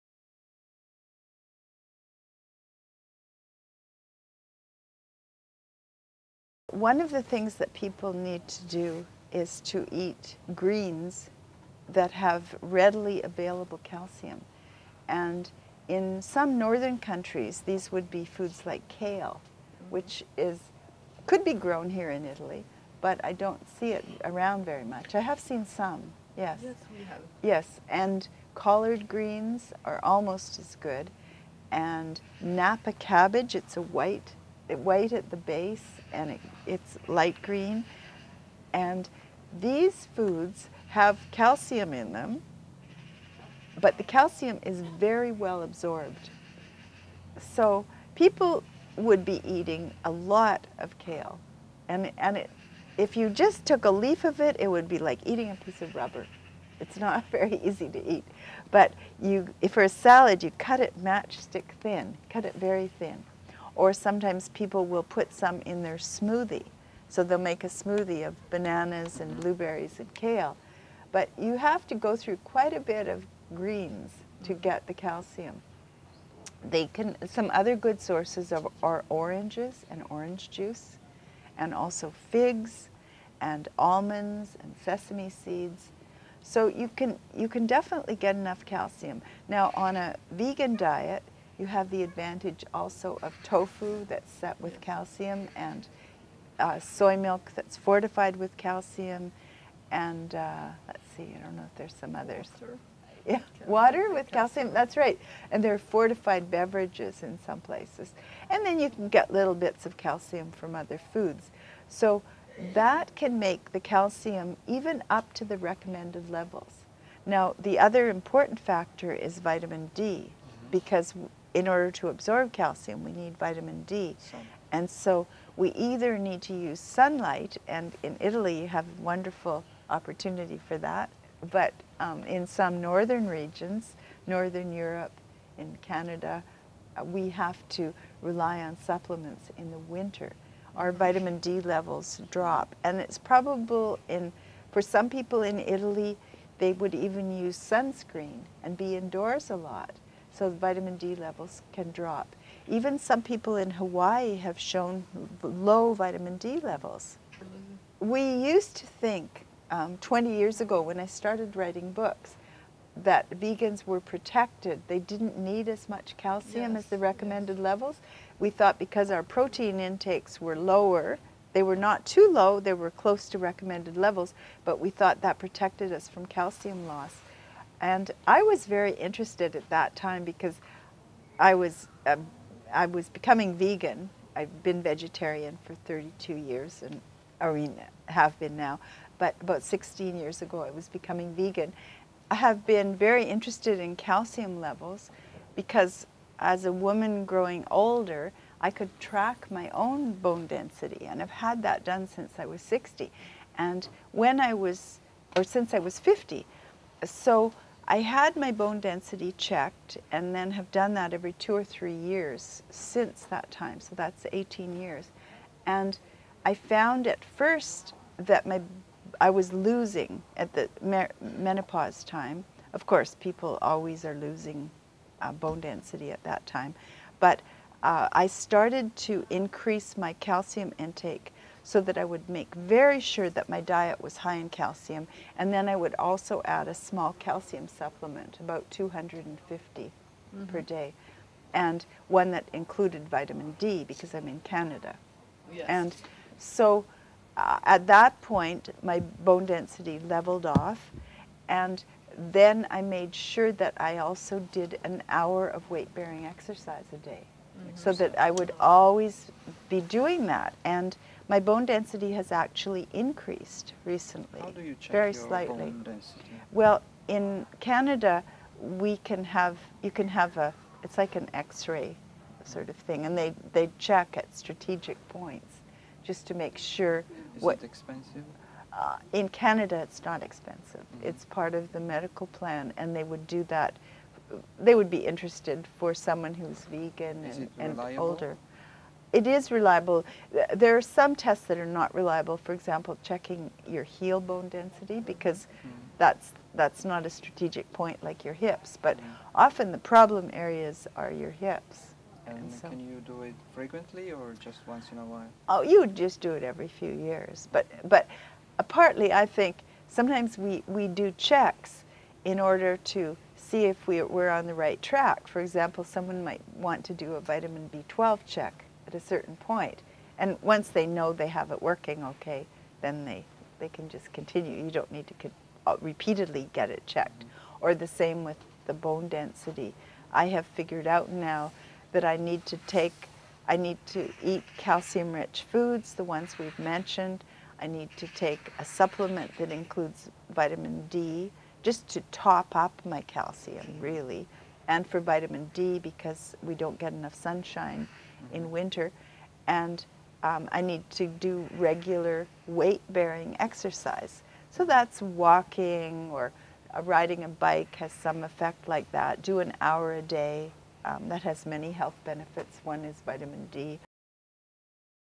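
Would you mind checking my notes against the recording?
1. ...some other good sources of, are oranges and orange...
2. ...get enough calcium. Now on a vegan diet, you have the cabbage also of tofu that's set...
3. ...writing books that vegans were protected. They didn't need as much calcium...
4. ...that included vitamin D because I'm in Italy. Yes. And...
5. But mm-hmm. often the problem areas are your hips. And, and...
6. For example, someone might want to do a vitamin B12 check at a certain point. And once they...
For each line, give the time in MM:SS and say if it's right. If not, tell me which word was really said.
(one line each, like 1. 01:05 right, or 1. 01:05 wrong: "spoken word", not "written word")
1. 01:17 right
2. 01:28 wrong: "advantage", not "cabbage"
3. 02:41 right
4. 04:02 wrong: "Canada", not "Italy"
5. 04:58 right
6. 05:15 right.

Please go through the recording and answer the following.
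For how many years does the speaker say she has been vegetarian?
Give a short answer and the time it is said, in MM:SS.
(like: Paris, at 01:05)
32, at 03:05.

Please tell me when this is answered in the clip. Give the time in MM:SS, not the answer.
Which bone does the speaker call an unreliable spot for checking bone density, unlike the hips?
04:53.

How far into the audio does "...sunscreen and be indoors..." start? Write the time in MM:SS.
02:27.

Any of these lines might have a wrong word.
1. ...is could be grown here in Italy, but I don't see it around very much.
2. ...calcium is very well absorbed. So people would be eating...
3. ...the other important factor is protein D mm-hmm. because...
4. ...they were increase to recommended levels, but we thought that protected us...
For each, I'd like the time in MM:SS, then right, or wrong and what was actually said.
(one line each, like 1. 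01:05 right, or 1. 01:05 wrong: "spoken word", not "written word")
1. 00:20 right
2. 00:44 right
3. 01:57 wrong: "vitamin", not "protein"
4. 02:52 wrong: "close", not "increase".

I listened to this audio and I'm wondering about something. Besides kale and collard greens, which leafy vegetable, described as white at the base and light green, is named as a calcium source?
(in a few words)
Napa cabbage.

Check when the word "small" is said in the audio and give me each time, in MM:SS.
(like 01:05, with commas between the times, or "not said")
03:56.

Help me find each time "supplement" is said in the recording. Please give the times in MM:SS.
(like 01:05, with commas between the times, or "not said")
02:18, 03:57, 05:38.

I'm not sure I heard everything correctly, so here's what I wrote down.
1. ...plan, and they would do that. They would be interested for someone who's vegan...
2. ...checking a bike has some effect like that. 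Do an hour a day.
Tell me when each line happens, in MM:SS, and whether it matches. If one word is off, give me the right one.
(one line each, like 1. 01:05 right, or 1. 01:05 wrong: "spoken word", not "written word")
1. 04:42 right
2. 05:56 wrong: "riding", not "checking".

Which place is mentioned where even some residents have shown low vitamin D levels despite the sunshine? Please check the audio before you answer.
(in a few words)
Hawaii.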